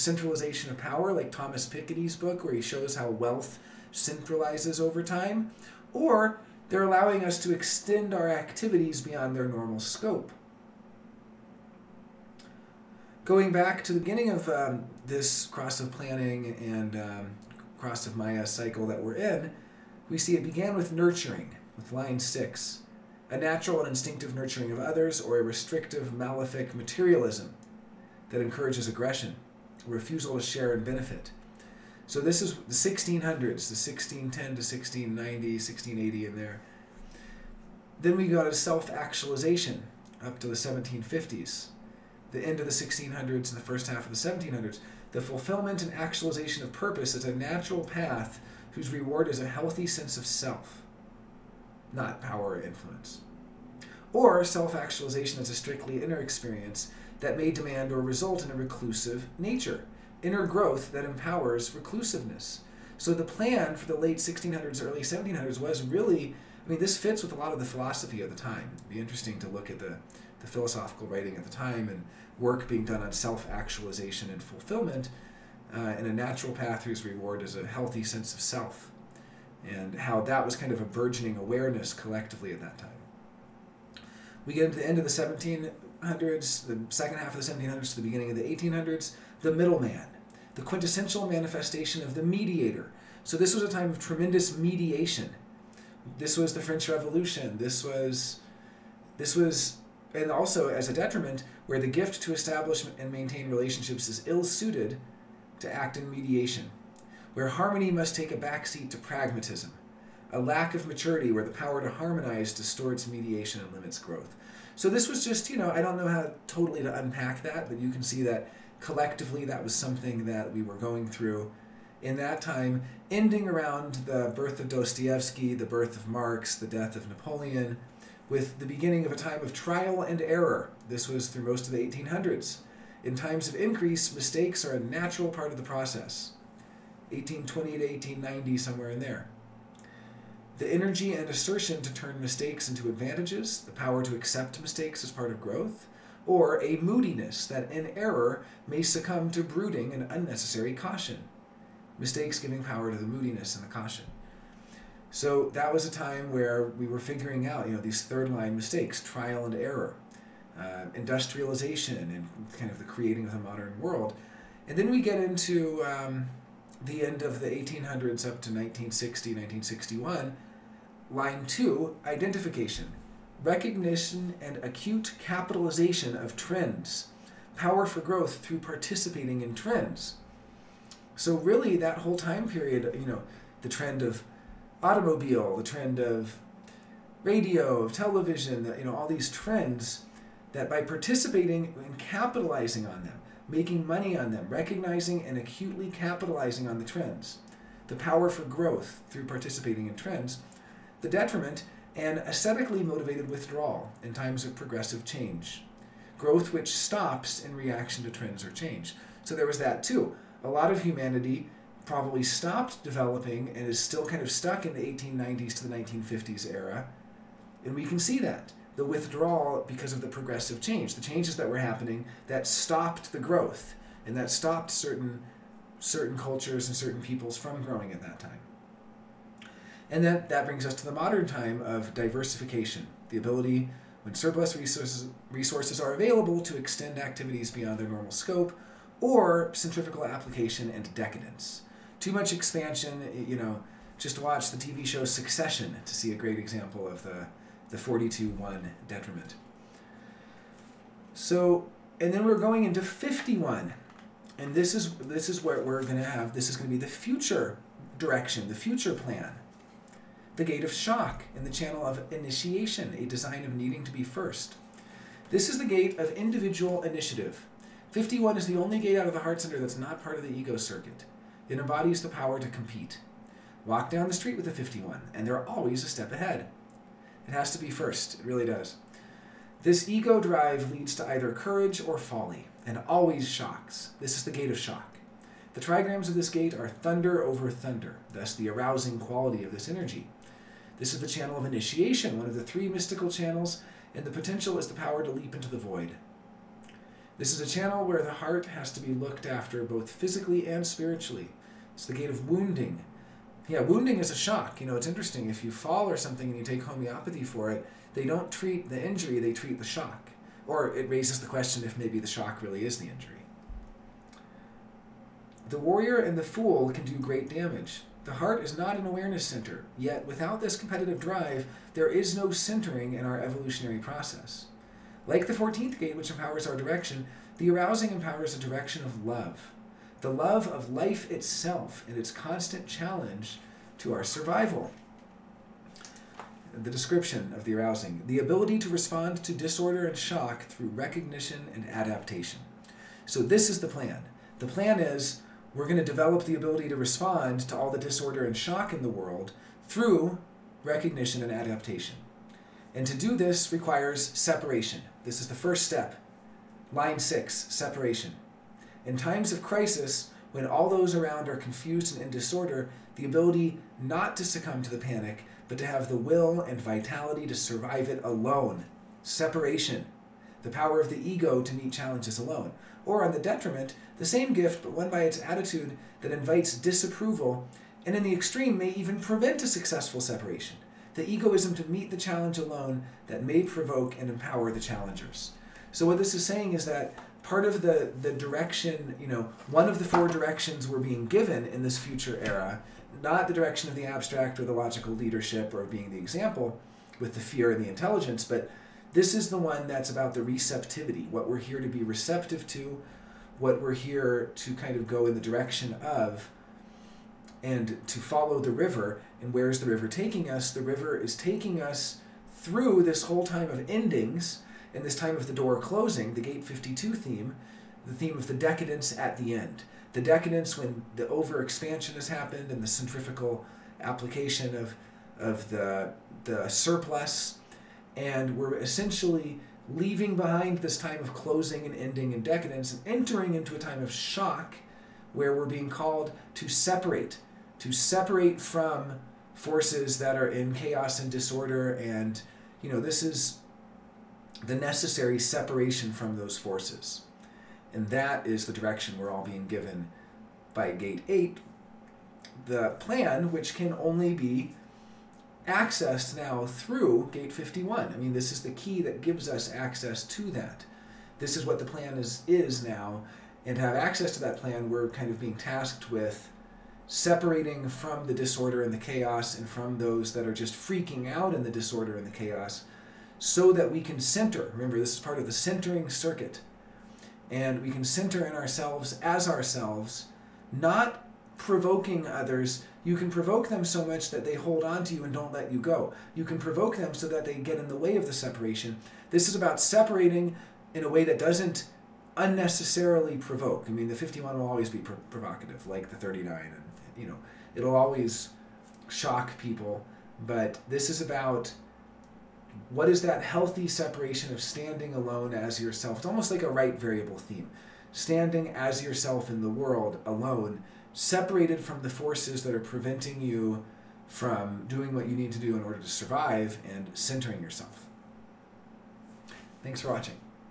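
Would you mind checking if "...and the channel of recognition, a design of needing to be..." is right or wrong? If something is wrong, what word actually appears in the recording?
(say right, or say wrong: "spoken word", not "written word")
wrong: "initiation", not "recognition".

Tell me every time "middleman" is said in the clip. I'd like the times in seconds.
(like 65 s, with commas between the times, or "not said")
89 s.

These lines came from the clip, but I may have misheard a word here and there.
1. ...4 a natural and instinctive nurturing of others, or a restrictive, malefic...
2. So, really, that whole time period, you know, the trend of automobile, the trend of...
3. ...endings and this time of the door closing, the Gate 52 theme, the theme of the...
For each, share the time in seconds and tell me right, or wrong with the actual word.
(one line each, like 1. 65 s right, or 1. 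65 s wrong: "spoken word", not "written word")
1. 22 s wrong: "6", not "4"
2. 181 s right
3. 413 s right.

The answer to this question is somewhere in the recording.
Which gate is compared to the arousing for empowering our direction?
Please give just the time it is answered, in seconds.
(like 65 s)
325 s.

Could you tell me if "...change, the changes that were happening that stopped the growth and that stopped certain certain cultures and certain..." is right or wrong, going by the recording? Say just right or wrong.
right.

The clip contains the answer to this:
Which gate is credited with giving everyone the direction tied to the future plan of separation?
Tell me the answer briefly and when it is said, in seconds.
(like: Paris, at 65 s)
Gate 8, at 450 s.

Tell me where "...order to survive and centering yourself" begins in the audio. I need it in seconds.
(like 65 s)
515 s.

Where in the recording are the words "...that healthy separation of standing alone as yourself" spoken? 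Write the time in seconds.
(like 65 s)
503 s.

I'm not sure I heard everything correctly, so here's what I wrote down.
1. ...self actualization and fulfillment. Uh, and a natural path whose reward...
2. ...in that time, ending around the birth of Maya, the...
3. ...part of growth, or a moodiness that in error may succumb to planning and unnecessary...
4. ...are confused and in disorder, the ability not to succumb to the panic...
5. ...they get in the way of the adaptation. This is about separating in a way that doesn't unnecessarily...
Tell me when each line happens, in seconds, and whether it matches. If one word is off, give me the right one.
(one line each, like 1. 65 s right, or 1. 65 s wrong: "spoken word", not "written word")
1. 73 s right
2. 122 s wrong: "Dostoevsky", not "Maya"
3. 145 s wrong: "brooding", not "planning"
4. 361 s right
5. 487 s wrong: "separation", not "adaptation".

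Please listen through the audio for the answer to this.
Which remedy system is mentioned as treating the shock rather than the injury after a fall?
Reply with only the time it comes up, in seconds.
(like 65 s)
306 s.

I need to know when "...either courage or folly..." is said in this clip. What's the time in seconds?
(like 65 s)
281 s.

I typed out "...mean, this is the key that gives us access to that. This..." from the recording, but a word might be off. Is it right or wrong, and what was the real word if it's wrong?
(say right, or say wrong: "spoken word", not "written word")
right.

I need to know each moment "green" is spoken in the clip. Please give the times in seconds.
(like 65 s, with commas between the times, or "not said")
not said.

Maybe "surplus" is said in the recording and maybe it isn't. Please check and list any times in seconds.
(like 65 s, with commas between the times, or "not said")
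234 s, 426 s.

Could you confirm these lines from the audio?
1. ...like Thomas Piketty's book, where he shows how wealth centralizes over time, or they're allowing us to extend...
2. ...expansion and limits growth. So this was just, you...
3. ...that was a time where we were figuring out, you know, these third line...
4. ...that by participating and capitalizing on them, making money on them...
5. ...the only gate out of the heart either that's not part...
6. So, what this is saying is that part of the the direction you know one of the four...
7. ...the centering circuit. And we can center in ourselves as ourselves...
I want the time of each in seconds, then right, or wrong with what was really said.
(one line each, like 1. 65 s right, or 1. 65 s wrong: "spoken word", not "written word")
1. 1 s right
2. 113 s wrong: "mediation", not "expansion"
3. 155 s right
4. 190 s right
5. 268 s wrong: "center", not "either"
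6. 385 s right
7. 475 s right.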